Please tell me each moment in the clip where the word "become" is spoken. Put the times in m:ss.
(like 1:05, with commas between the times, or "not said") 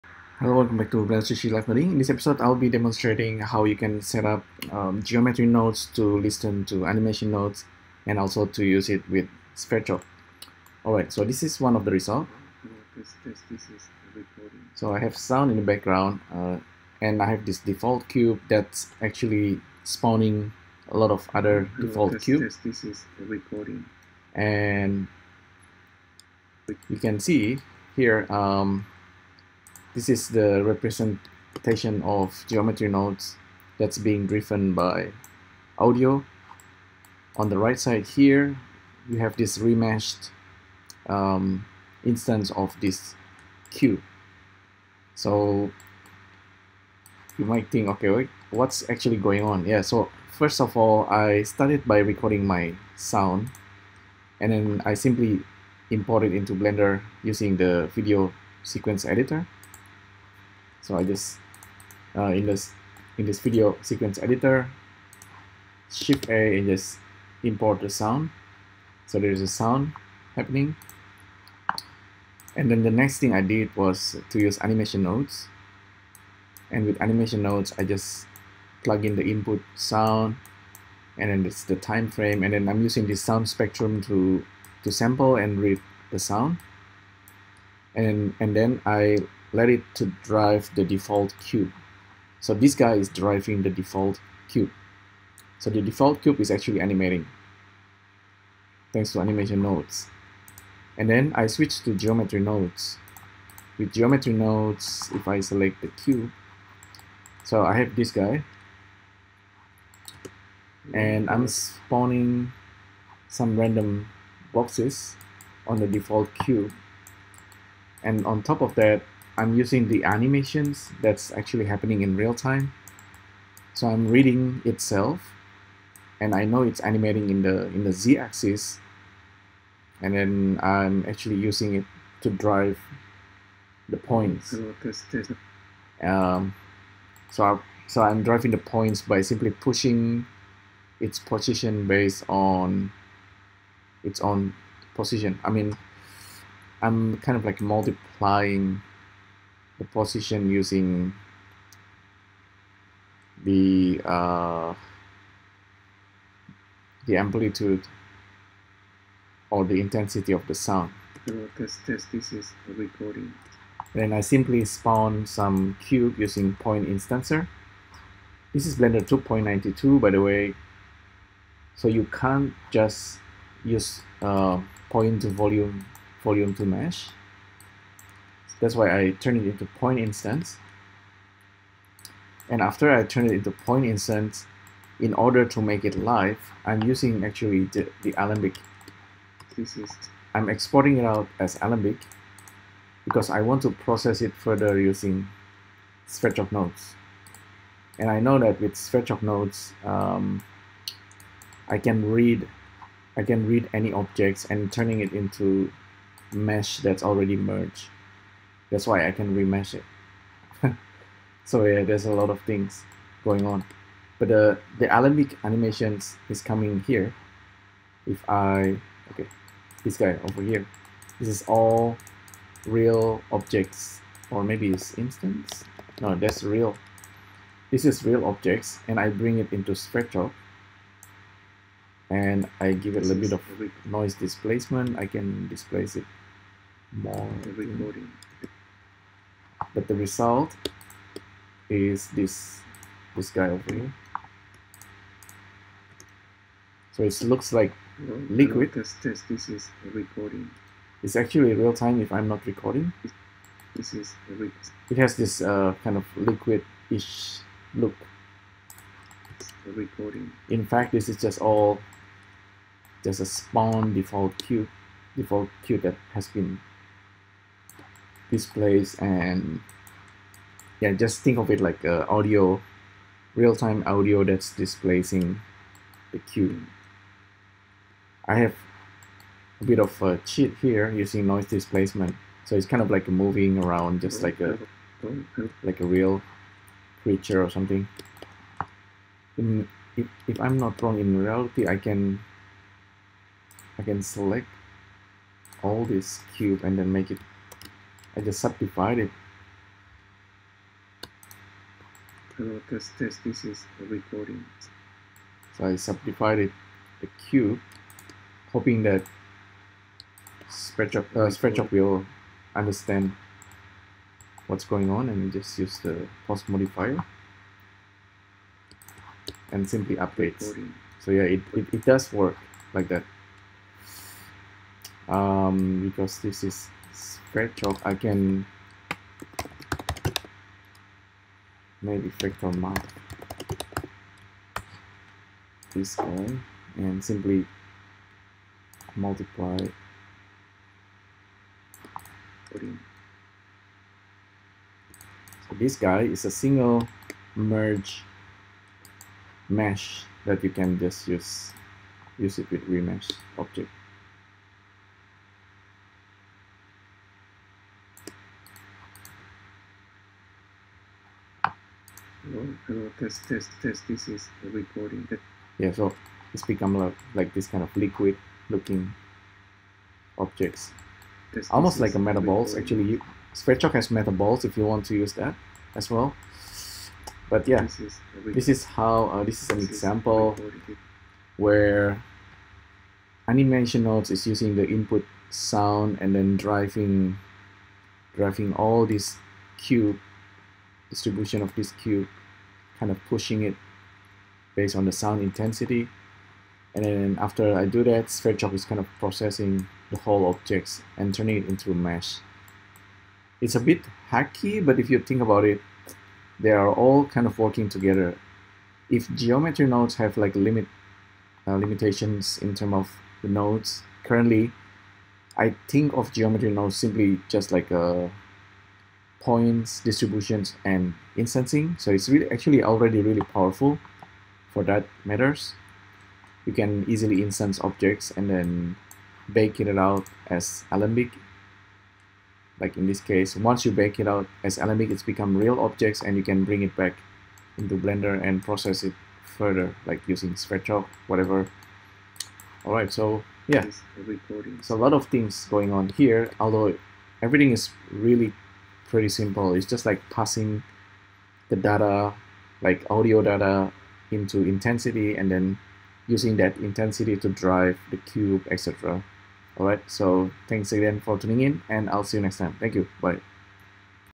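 6:06, 7:15.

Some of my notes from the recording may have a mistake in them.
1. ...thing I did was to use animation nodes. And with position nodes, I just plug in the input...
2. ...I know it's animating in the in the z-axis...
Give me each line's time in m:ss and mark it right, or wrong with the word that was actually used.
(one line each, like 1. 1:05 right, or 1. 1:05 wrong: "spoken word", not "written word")
1. 1:13 wrong: "animation", not "position"
2. 2:06 right.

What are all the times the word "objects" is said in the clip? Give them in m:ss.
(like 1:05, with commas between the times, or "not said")
3:23, 3:43, 3:48, 5:53, 6:10, 6:40, 7:07, 7:15.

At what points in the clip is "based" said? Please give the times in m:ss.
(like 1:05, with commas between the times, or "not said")
2:21, 6:34.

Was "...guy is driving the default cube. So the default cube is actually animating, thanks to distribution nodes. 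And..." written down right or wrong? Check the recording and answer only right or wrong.
wrong.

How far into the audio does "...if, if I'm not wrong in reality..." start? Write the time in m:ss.
4:49.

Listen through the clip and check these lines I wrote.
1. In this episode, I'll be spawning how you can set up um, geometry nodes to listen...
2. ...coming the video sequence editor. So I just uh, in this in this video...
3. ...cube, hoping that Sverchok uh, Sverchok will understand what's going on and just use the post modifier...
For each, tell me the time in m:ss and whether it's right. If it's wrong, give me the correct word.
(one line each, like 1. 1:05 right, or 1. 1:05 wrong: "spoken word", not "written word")
1. 0:01 wrong: "demonstrating", not "spawning"
2. 0:57 wrong: "using", not "coming"
3. 5:07 right.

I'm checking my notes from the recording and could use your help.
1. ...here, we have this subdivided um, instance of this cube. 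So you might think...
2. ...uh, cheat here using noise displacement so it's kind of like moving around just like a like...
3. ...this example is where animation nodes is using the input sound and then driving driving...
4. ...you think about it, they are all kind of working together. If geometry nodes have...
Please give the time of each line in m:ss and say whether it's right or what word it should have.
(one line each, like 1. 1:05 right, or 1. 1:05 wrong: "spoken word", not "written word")
1. 0:38 wrong: "remeshed", not "subdivided"
2. 4:40 right
3. 6:19 right
4. 6:44 right.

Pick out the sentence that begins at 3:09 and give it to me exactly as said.
This is I'm exporting it out as Alembic because I want to process it further using Sverchok nodes.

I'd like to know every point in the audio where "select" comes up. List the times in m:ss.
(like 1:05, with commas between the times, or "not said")
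1:45, 4:54.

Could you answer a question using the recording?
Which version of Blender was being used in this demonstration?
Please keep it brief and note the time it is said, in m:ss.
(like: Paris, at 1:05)
2.92, at 2:49.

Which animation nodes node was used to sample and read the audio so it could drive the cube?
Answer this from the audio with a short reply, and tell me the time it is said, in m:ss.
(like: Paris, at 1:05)
Sound spectrum, at 1:23.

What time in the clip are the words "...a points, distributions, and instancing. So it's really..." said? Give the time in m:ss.
6:57.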